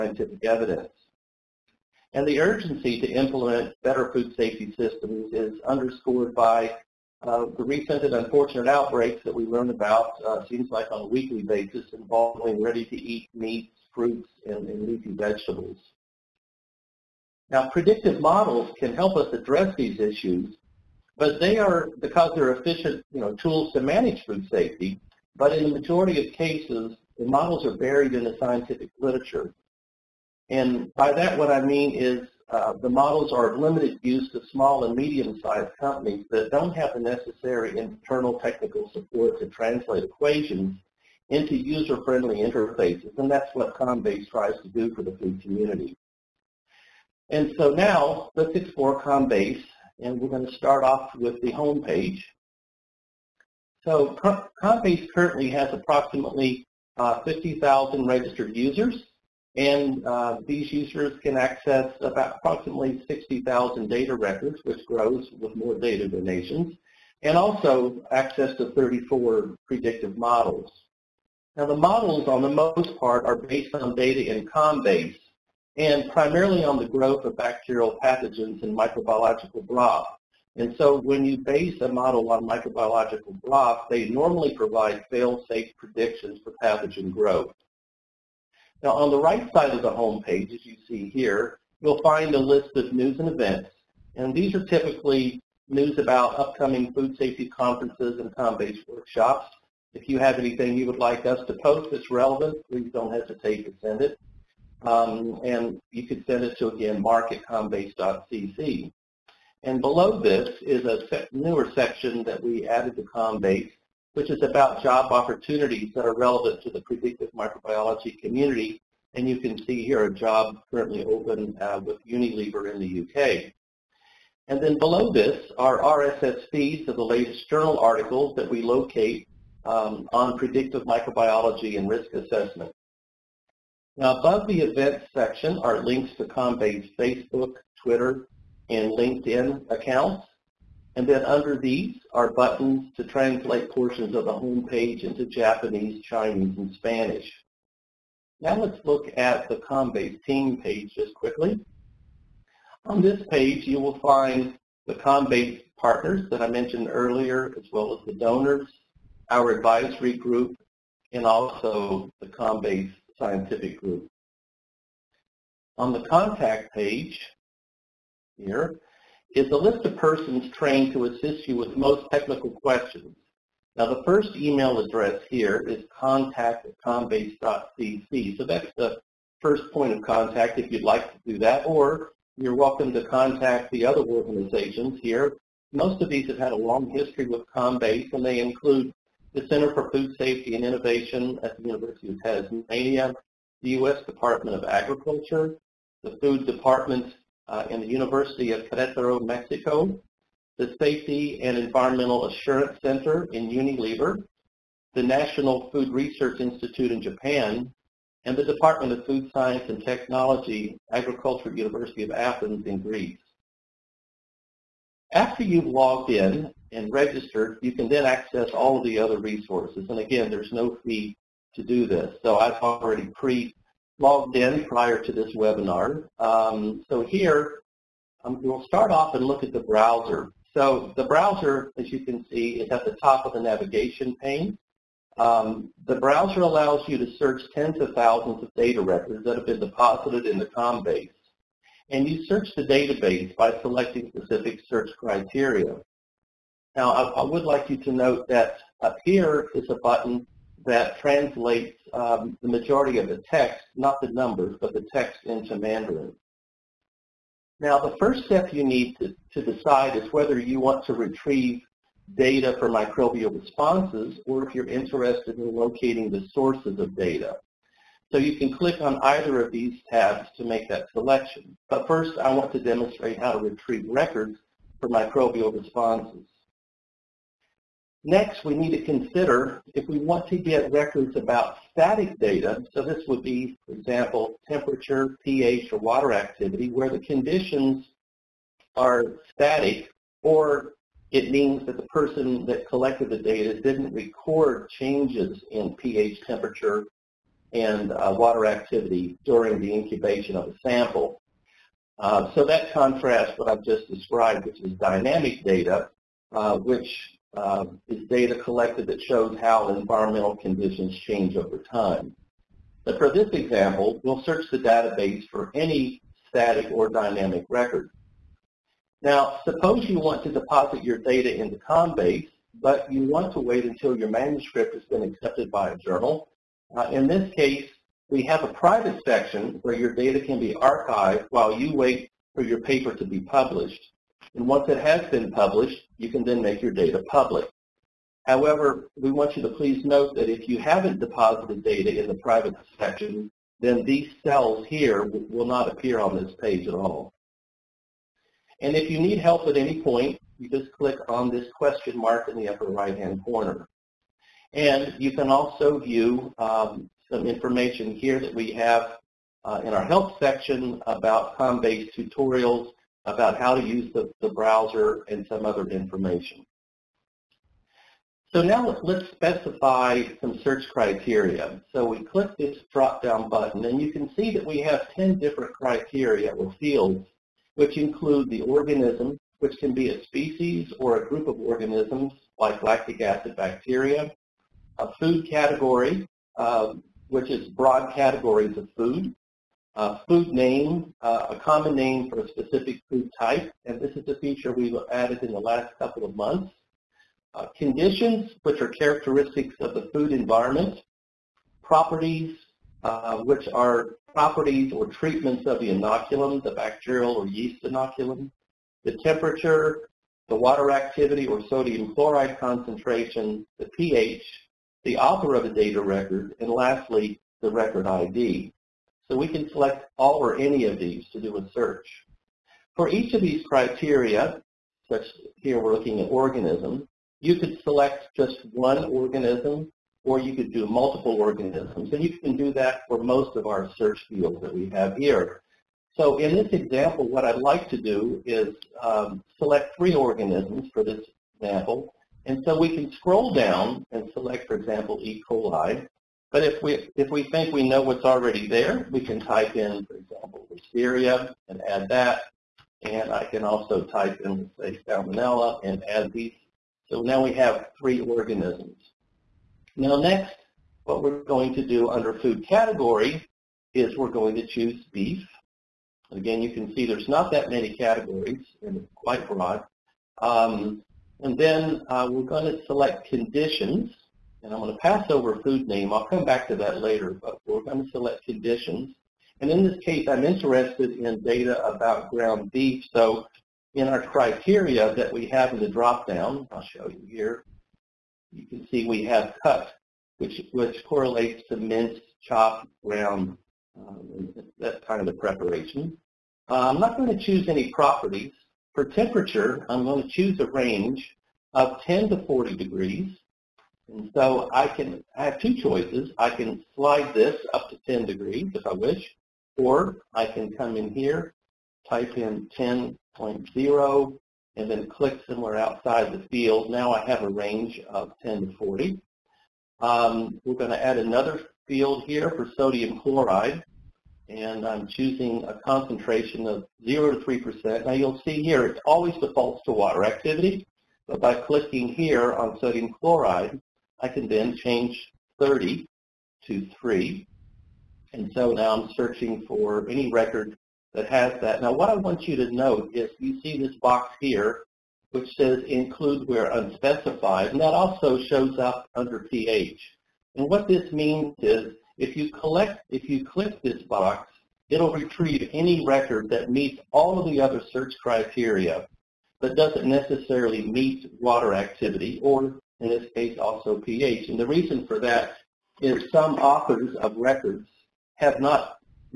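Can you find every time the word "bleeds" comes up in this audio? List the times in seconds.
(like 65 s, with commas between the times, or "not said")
not said.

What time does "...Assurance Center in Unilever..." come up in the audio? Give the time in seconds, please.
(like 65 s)
202 s.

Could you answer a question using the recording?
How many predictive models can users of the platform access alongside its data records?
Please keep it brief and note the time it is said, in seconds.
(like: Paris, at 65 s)
34, at 68 s.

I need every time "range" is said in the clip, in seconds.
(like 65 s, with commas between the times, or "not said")
500 s, 517 s.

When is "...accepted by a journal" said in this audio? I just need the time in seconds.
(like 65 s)
325 s.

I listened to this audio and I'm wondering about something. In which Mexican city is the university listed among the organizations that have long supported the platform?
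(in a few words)
Querétaro.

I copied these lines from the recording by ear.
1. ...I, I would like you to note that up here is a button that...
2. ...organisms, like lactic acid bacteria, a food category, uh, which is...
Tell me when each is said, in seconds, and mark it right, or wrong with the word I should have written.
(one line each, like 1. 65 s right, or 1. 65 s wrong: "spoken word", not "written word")
1. 246 s right
2. 381 s right.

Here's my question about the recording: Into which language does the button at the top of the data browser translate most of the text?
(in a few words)
Mandarin.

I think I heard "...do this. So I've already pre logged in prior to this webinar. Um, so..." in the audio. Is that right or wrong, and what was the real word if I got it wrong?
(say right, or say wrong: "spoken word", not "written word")
right.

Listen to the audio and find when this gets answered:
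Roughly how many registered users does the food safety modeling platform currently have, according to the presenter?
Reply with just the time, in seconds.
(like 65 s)
57 s.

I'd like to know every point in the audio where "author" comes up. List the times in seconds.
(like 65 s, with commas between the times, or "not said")
414 s, 566 s.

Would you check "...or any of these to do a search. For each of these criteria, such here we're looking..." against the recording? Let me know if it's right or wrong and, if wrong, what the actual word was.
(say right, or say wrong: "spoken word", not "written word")
right.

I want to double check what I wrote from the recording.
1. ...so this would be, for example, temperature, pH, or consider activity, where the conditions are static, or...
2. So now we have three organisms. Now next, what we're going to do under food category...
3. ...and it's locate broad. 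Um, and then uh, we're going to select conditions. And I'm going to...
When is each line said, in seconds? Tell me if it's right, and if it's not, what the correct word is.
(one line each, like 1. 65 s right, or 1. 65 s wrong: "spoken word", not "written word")
1. 282 s wrong: "water", not "consider"
2. 456 s right
3. 468 s wrong: "quite", not "locate".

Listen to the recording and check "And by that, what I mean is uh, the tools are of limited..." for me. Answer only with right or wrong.
wrong.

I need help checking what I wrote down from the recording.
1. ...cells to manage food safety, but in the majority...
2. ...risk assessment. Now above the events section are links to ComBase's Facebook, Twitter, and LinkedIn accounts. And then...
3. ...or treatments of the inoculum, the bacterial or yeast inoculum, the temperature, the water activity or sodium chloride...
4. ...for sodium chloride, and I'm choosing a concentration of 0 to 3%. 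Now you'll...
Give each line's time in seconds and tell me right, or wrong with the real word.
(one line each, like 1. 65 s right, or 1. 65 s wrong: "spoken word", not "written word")
1. 23 s wrong: "tools", not "cells"
2. 131 s right
3. 404 s right
4. 522 s right.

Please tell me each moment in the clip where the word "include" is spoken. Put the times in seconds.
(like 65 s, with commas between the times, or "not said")
188 s, 377 s, 545 s.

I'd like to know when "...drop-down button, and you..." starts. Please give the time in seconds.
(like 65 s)
372 s.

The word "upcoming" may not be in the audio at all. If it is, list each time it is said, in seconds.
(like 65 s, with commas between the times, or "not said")
96 s.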